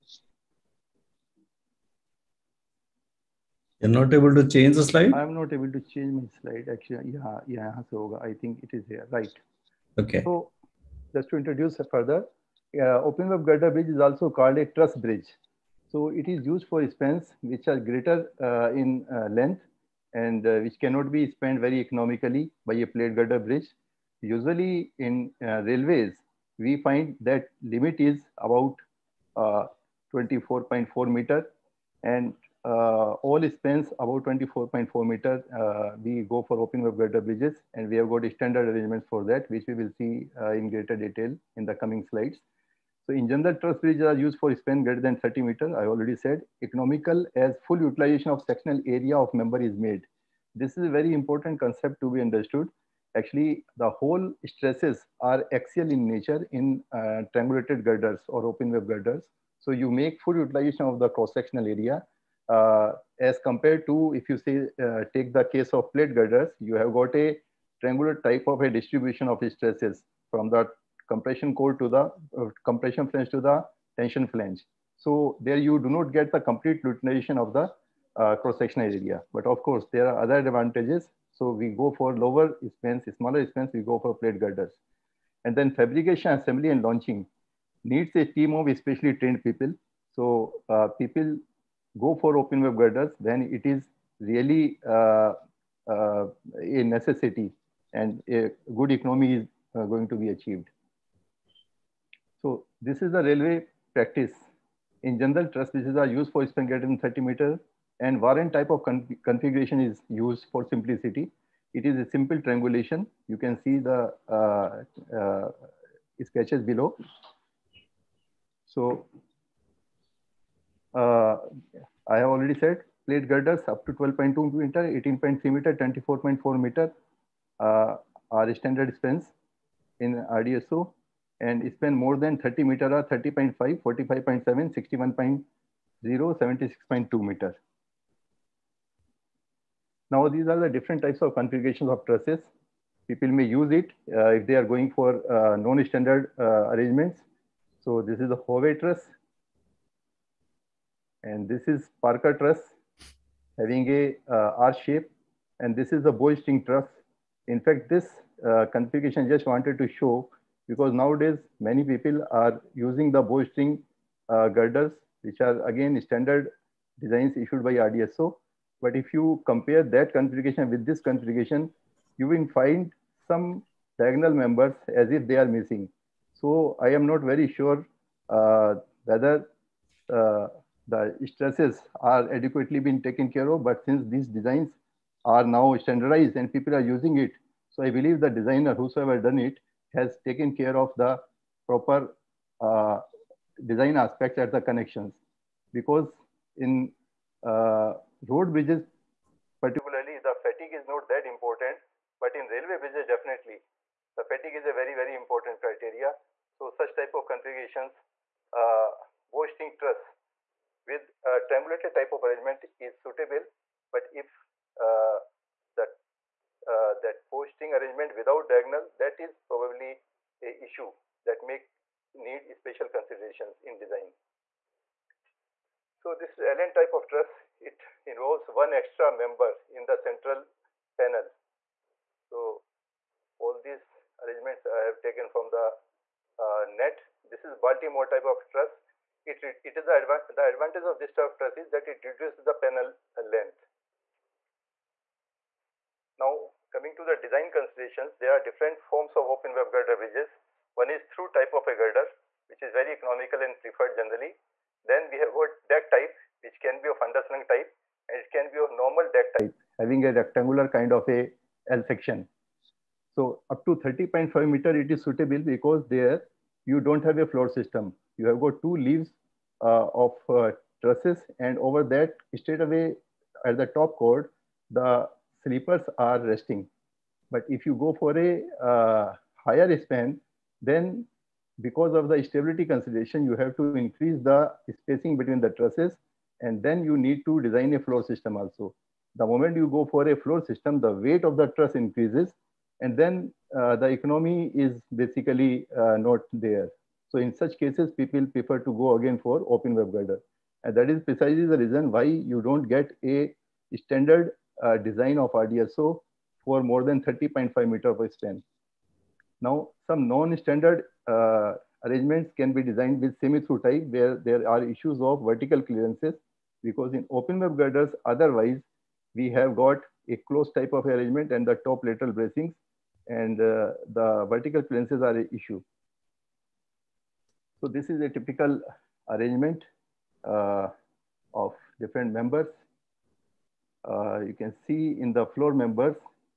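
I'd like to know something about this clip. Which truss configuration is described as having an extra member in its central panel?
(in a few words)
LN type.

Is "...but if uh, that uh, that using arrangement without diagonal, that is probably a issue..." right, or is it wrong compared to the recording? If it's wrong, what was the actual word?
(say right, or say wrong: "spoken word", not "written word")
wrong: "posting", not "using".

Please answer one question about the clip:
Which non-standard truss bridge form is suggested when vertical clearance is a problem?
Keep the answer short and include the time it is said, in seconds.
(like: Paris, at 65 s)
semi-through type, at 313 s.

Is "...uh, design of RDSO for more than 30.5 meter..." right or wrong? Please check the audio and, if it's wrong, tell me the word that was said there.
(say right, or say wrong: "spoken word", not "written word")
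right.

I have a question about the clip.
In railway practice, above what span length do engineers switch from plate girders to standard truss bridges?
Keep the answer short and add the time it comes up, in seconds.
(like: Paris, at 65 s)
24.4 meters, at 34 s.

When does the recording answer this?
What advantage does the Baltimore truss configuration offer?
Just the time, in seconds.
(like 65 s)
242 s.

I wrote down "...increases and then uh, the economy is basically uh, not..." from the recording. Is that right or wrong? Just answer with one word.
right.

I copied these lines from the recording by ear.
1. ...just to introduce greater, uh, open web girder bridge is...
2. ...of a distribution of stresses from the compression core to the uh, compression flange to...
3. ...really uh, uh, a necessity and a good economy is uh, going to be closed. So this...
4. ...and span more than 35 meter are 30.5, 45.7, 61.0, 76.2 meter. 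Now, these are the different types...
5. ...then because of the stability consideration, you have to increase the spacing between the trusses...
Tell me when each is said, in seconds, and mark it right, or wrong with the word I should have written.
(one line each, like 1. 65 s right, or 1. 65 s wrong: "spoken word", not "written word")
1. 11 s wrong: "further", not "greater"
2. 68 s right
3. 94 s wrong: "achieved", not "closed"
4. 131 s wrong: "30", not "35"
5. 280 s right.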